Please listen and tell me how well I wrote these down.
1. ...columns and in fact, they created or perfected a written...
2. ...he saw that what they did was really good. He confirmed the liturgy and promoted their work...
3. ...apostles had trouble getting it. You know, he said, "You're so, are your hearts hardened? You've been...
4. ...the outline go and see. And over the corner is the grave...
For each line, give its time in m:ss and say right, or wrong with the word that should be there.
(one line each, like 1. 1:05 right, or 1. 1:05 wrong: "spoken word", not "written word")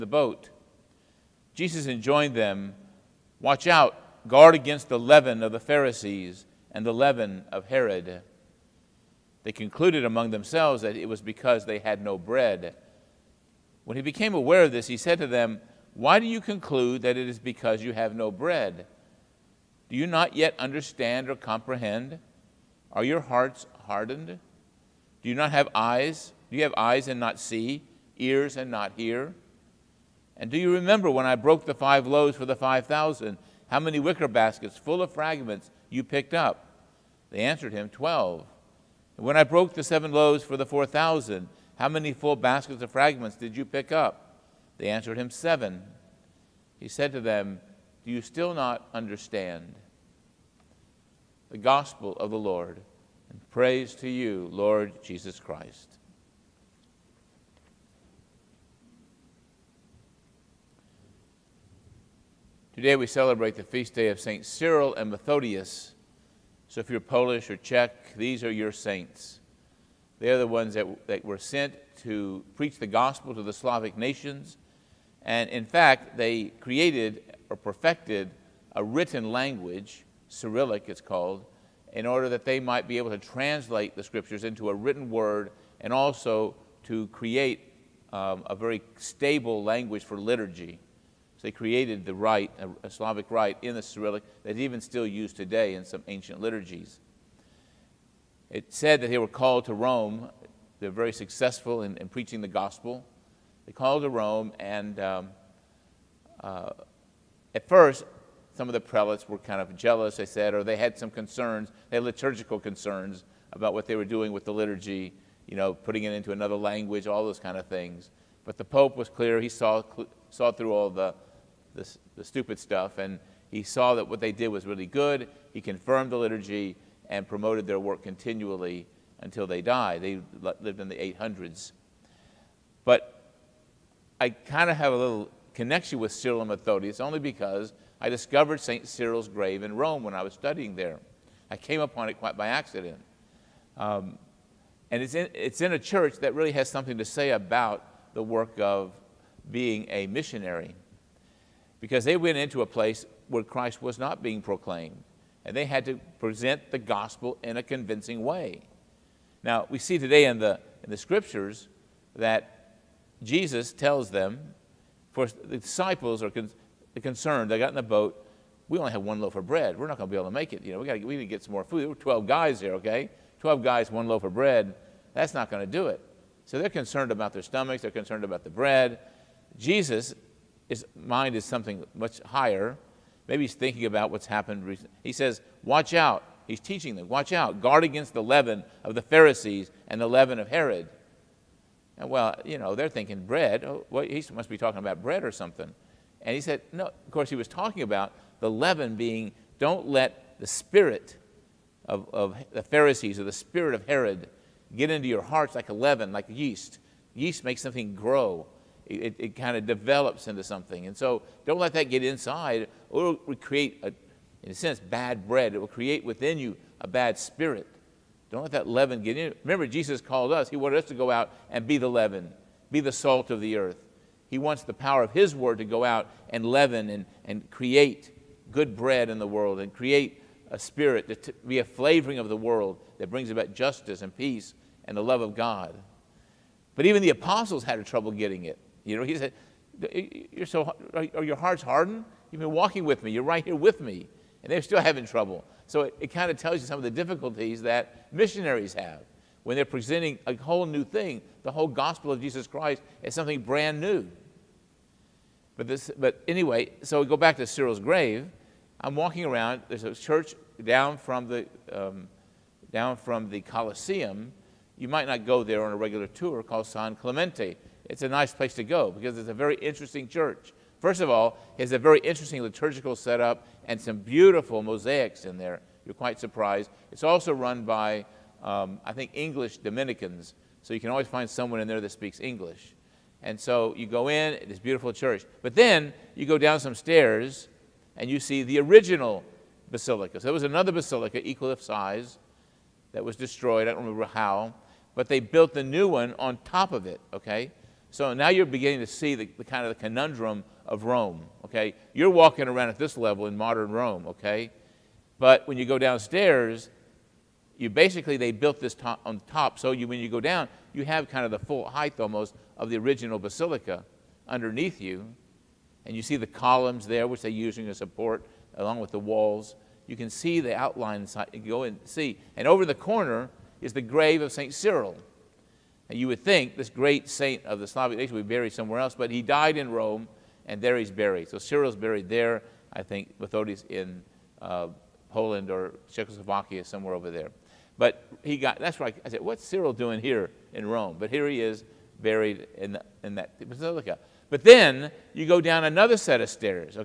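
1. 1:13 wrong: "nations", not "columns"
2. 2:03 right
3. 3:57 right
4. 5:20 right.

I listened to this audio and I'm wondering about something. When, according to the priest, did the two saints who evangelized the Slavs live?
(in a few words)
800s.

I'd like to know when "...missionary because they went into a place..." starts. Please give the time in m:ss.
2:30.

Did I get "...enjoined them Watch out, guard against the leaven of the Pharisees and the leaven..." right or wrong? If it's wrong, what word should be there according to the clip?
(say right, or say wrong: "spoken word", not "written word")
right.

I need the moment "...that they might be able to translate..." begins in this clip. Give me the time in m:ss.
1:22.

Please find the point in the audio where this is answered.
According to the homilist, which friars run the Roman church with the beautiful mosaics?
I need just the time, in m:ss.
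4:39.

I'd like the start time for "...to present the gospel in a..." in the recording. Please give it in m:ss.
2:35.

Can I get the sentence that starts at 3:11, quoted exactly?
And well, you know, they're thinking bread.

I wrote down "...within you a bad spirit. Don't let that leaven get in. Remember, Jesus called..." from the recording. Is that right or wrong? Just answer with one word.
right.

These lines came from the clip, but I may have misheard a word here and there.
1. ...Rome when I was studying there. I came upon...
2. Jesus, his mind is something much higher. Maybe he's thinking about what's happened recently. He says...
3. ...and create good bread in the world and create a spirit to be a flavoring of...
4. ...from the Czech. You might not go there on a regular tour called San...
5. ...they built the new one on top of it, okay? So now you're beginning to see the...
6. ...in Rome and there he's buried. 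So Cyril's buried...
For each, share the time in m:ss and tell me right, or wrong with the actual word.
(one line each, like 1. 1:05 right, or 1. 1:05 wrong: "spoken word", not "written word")
1. 2:19 right
2. 2:59 right
3. 3:47 right
4. 4:22 wrong: "Colosseum", not "Czech"
5. 4:55 right
6. 5:29 right.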